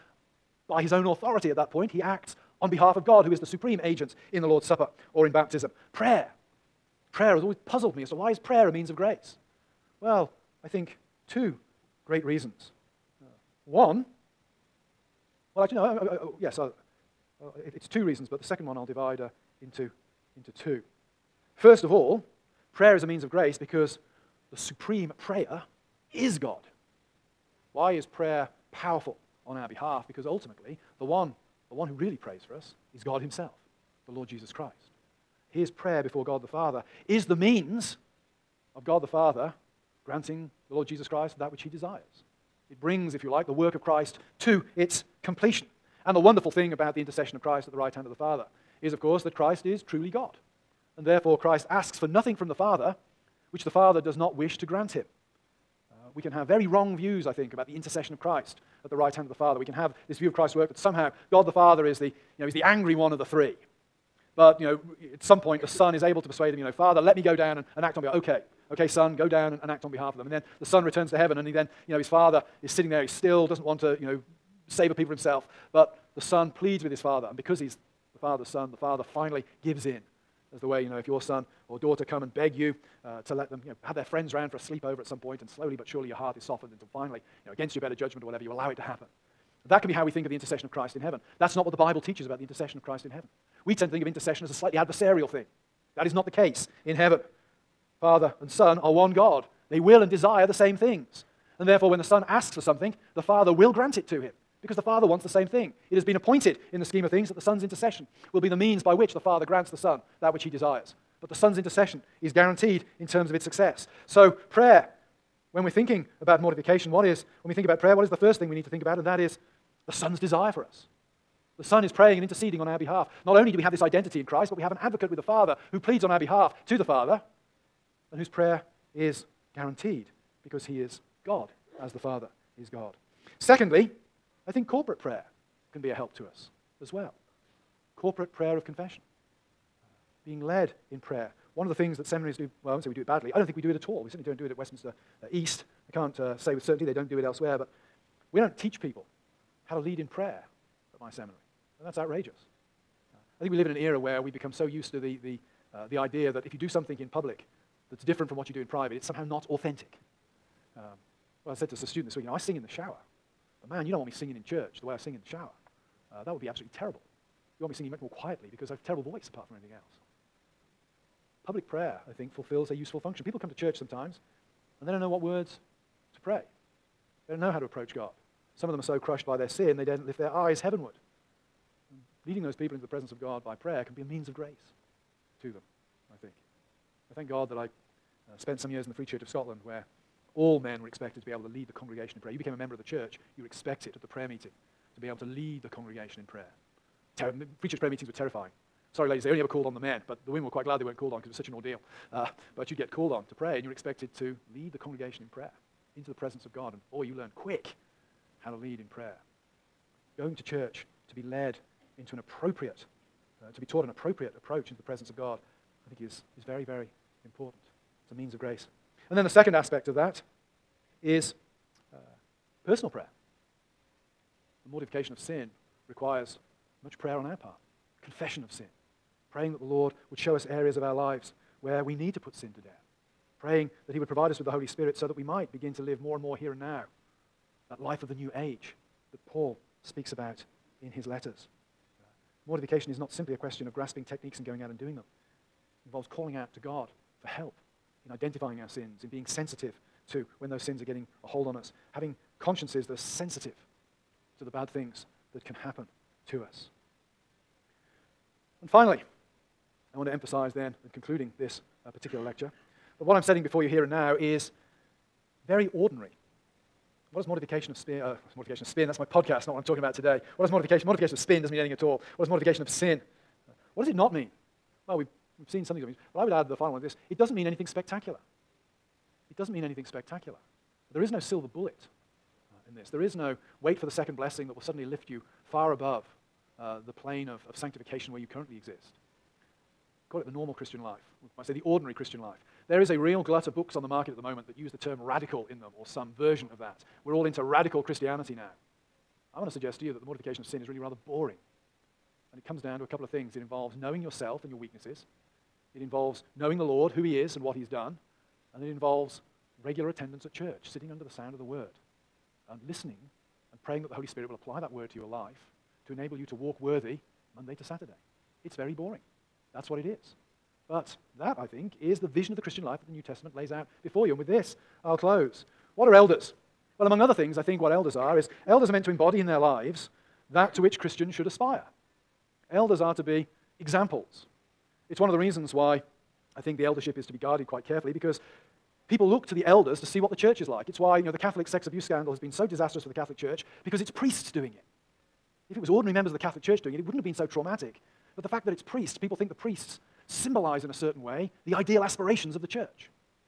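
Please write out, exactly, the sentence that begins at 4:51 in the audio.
We might say the ordinary Christian life.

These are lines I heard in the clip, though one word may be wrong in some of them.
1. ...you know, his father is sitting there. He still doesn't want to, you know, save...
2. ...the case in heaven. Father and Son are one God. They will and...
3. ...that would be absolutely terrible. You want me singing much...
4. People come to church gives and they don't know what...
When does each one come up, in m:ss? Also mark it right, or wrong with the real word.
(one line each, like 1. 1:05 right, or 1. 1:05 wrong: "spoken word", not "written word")
1. 1:11 right
2. 1:36 right
3. 2:46 right
4. 2:53 wrong: "sometimes", not "gives".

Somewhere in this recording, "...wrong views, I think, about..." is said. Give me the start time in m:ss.
0:56.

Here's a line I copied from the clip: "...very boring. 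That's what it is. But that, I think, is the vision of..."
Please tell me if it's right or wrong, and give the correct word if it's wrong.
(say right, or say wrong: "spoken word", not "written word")
right.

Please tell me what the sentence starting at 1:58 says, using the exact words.
And that is the Son's desire for us.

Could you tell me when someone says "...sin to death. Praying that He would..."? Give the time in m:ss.
3:52.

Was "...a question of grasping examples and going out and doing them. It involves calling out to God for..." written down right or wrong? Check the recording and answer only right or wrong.
wrong.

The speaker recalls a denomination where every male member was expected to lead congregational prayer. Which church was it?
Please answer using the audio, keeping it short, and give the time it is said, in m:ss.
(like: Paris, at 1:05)
Free Church of Scotland, at 3:08.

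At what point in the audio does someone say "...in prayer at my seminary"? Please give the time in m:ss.
2:29.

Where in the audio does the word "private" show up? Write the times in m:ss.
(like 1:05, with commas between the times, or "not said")
2:38.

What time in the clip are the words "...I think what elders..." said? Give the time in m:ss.
5:27.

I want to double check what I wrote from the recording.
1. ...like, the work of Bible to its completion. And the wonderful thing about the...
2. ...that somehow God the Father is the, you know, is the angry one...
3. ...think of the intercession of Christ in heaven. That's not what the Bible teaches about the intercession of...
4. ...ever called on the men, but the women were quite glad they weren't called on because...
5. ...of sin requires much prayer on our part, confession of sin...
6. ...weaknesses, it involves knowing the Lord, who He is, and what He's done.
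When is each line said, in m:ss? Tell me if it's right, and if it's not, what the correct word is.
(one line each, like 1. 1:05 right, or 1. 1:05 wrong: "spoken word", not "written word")
1. 0:43 wrong: "Christ", not "Bible"
2. 1:00 right
3. 1:30 right
4. 3:19 right
5. 3:45 right
6. 5:04 right.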